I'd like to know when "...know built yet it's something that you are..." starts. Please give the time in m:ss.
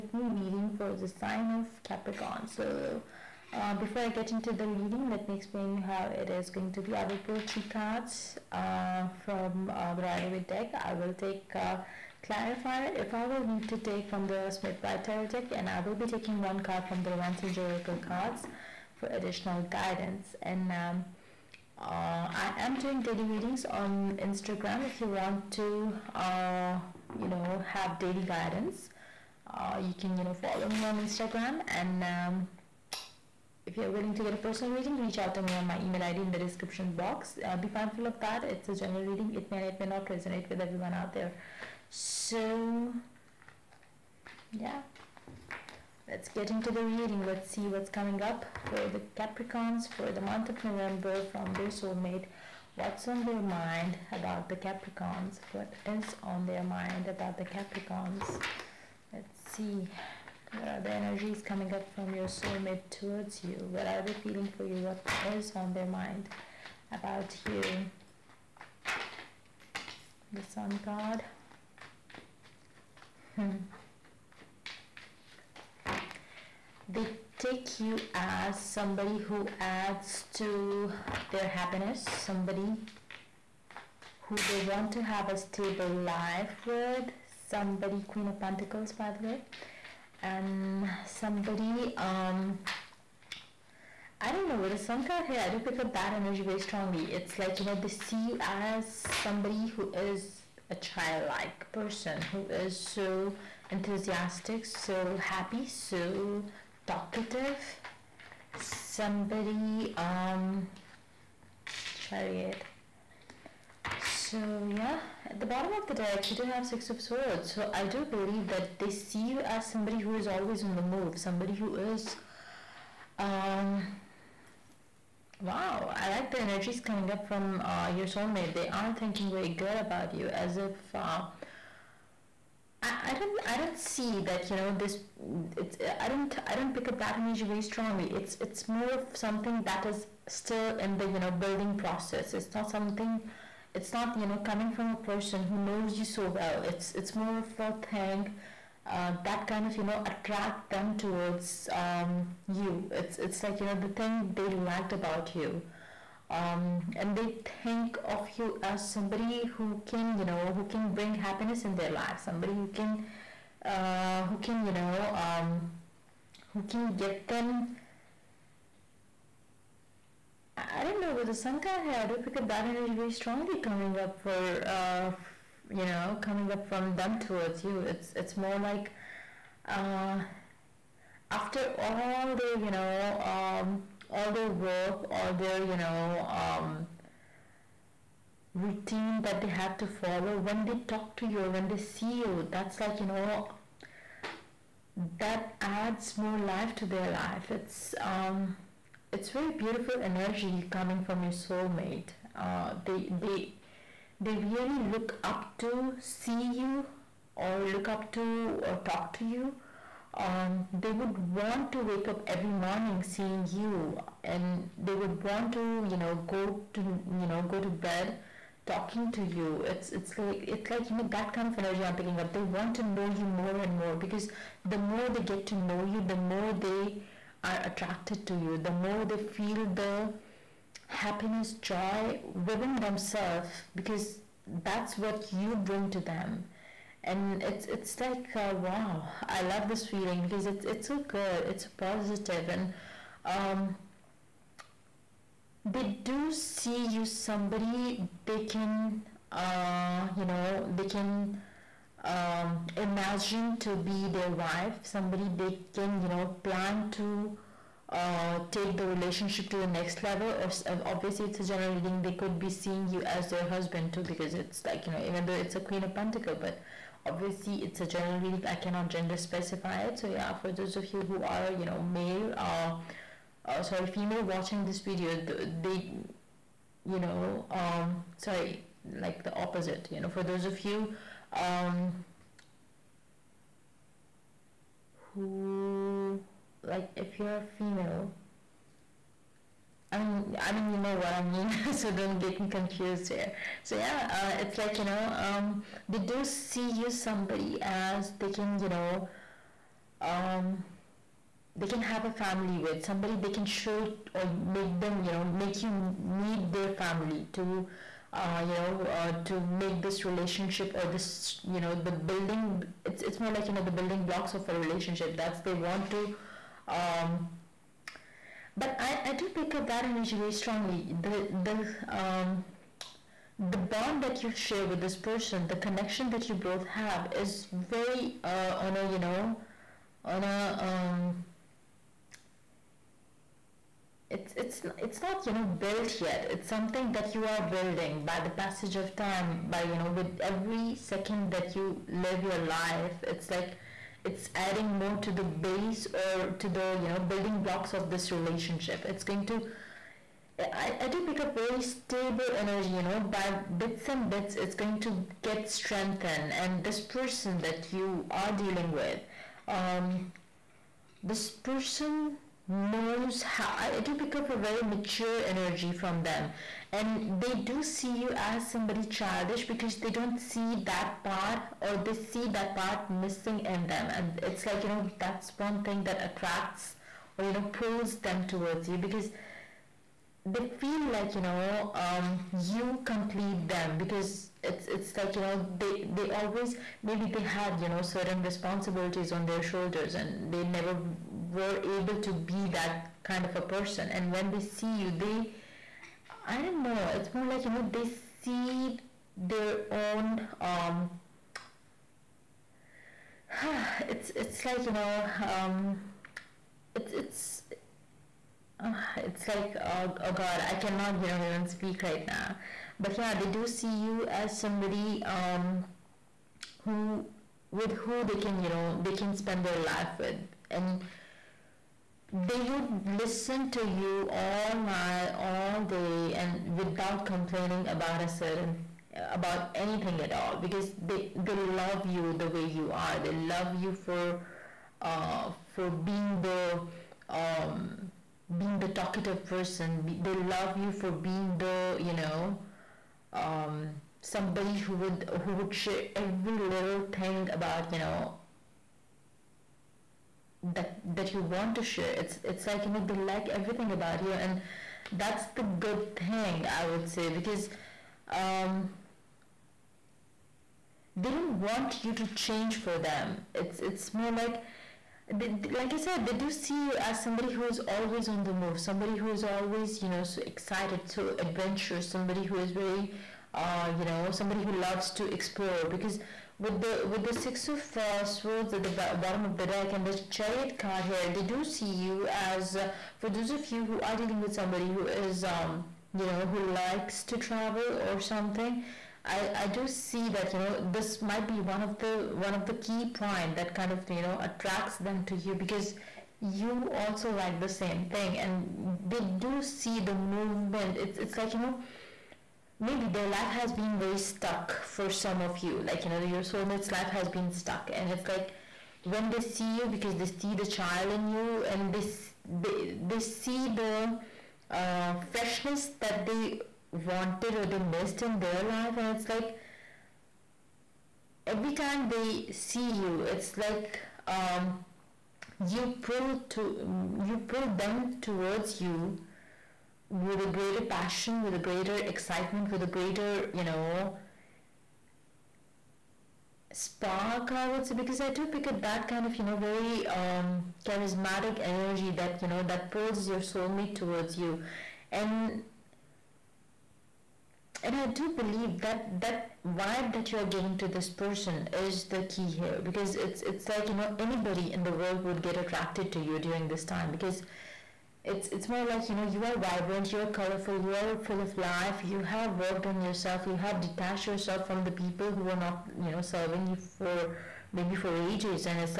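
5:35.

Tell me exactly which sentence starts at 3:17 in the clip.
It's, um, it's very beautiful energy coming from your soulmate.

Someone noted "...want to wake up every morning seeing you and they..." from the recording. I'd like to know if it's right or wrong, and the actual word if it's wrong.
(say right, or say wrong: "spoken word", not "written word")
right.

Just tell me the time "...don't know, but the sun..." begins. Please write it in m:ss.
2:50.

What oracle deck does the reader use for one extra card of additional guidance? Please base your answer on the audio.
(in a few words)
Romance Angels Oracle.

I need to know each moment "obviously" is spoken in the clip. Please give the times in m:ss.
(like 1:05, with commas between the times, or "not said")
4:20, 4:27.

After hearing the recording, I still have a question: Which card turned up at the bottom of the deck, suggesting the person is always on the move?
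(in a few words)
Six of Swords.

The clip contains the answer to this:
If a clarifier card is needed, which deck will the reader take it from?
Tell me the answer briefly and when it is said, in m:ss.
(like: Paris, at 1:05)
Smith Waite Tarot, at 0:14.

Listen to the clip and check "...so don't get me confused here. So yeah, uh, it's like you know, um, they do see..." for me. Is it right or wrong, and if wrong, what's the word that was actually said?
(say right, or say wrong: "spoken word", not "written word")
right.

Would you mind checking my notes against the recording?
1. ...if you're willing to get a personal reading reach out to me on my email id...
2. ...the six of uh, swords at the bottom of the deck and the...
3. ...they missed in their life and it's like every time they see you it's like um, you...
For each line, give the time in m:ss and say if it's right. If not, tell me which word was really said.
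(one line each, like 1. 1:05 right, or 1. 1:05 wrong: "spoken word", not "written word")
1. 0:33 right
2. 7:57 right
3. 8:37 right.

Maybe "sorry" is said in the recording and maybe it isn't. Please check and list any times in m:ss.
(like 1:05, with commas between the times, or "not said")
4:33, 4:38.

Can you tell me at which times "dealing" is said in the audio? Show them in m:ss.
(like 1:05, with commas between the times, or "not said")
5:58, 8:04.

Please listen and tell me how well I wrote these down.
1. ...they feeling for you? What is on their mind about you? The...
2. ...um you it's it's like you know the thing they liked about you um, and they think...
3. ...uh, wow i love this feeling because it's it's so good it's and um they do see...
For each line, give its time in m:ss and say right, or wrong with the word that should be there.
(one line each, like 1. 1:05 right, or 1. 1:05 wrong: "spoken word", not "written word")
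1. 1:04 right
2. 2:31 right
3. 3:58 right.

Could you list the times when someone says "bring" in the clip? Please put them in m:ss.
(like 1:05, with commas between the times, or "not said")
2:40, 3:55.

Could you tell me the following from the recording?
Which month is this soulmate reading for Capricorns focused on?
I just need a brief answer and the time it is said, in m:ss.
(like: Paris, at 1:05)
November, at 0:50.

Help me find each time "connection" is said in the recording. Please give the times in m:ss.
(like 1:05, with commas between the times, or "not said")
5:25.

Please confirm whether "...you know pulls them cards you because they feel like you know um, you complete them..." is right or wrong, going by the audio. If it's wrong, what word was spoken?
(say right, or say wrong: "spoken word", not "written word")
wrong: "towards", not "cards".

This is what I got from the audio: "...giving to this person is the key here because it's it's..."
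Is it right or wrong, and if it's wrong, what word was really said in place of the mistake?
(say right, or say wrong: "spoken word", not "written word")
right.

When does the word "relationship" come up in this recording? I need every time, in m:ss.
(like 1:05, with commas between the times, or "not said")
4:18, 5:10, 5:14, 5:48.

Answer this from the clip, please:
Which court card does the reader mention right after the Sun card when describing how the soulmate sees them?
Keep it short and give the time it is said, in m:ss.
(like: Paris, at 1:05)
Queen of Pentacles, at 1:28.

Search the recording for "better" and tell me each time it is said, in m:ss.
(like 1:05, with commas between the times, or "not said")
not said.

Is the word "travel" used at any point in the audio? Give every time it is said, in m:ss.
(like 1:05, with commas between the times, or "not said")
8:07.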